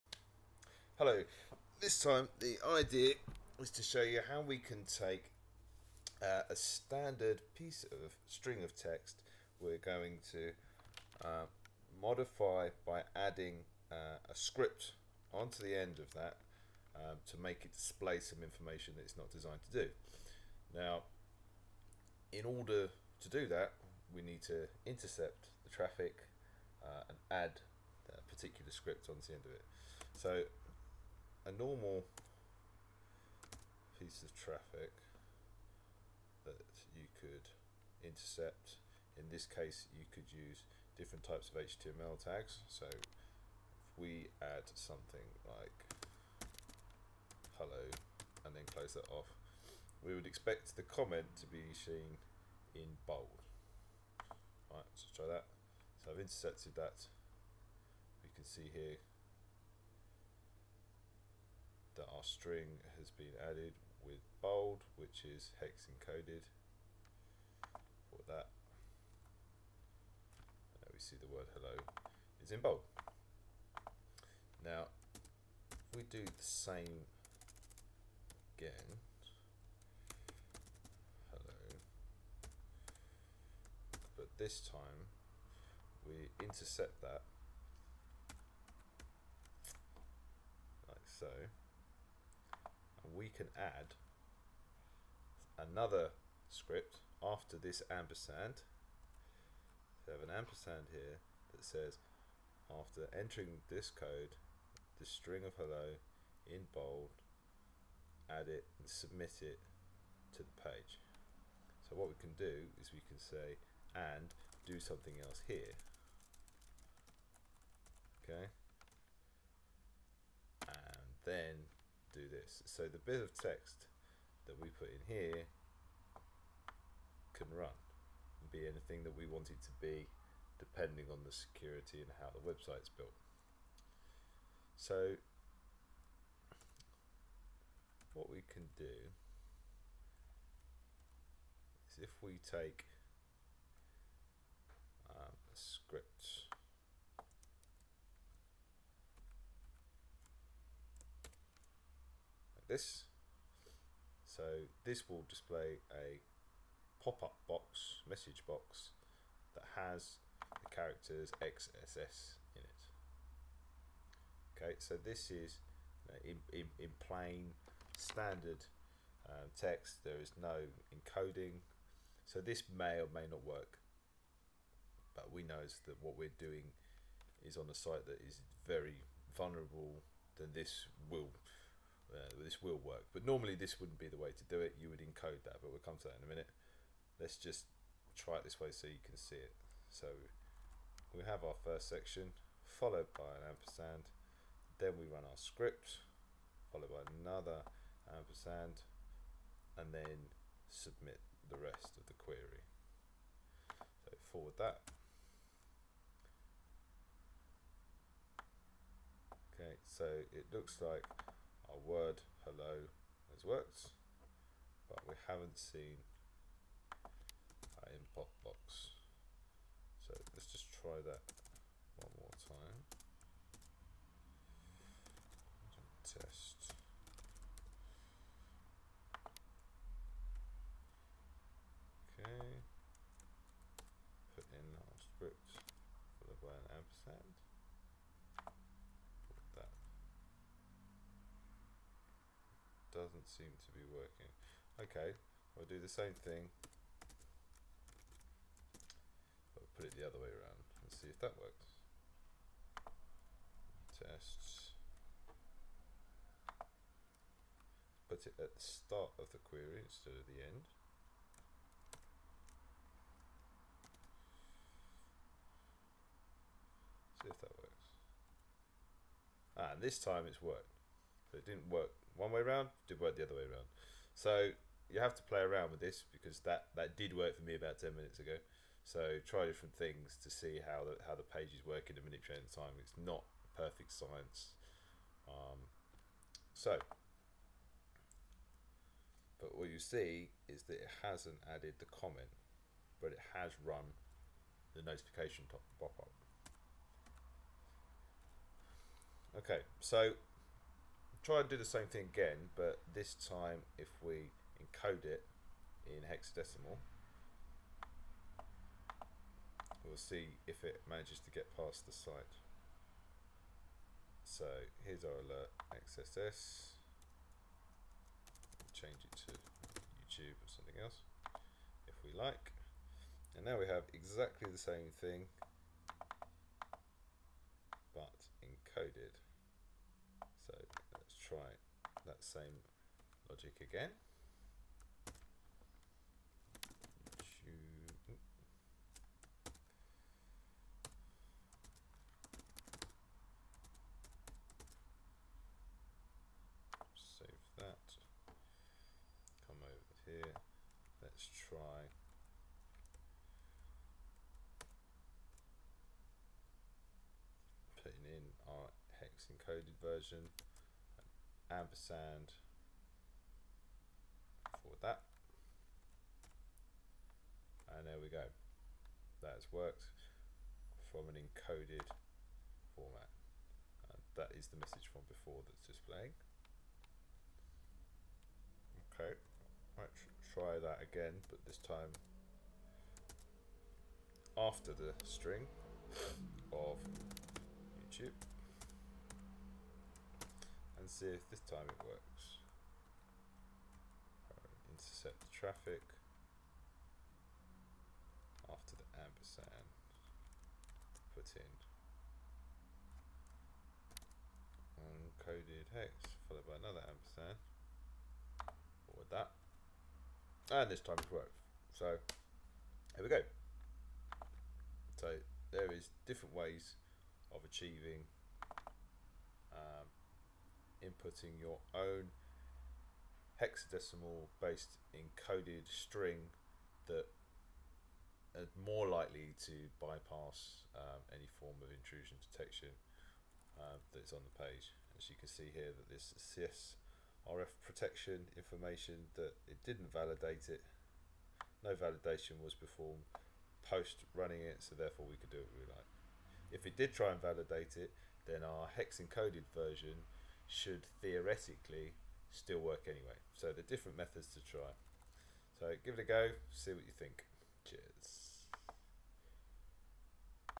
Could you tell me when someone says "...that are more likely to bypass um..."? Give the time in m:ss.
7:06.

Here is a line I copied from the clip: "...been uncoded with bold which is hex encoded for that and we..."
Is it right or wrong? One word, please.
wrong.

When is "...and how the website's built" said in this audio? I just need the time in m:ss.
2:12.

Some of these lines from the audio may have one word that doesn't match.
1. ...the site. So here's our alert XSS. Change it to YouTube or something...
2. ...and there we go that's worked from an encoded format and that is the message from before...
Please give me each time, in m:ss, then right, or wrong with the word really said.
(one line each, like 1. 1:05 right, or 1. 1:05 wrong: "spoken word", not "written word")
1. 5:11 right
2. 6:07 right.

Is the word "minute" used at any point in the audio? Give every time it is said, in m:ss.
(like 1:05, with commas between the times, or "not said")
3:06, 4:37.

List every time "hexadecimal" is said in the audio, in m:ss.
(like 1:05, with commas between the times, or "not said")
5:06, 7:03.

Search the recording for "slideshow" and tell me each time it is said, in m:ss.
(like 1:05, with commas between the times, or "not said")
not said.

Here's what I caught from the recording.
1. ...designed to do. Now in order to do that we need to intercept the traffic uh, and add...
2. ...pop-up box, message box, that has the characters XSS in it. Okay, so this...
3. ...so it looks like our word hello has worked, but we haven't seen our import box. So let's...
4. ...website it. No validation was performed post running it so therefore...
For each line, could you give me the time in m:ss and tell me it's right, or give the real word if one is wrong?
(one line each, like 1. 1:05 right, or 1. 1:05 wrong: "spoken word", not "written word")
1. 0:19 right
2. 2:37 right
3. 3:29 right
4. 7:19 wrong: "validate", not "website".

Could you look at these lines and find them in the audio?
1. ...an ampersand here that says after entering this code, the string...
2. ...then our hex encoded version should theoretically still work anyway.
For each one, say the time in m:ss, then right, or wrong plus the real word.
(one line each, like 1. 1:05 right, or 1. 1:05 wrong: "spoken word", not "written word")
1. 1:40 right
2. 7:28 right.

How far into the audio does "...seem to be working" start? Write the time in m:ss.
4:03.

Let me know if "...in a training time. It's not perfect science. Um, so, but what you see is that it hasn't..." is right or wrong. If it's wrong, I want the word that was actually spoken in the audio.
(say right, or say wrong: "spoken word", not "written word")
right.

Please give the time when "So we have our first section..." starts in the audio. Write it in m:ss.
3:09.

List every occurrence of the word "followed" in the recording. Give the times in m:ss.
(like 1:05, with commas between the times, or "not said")
3:12, 3:16, 6:46.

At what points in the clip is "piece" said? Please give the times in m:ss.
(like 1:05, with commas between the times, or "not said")
0:07, 0:33.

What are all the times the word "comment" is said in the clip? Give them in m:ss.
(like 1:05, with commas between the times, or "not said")
0:50, 4:51.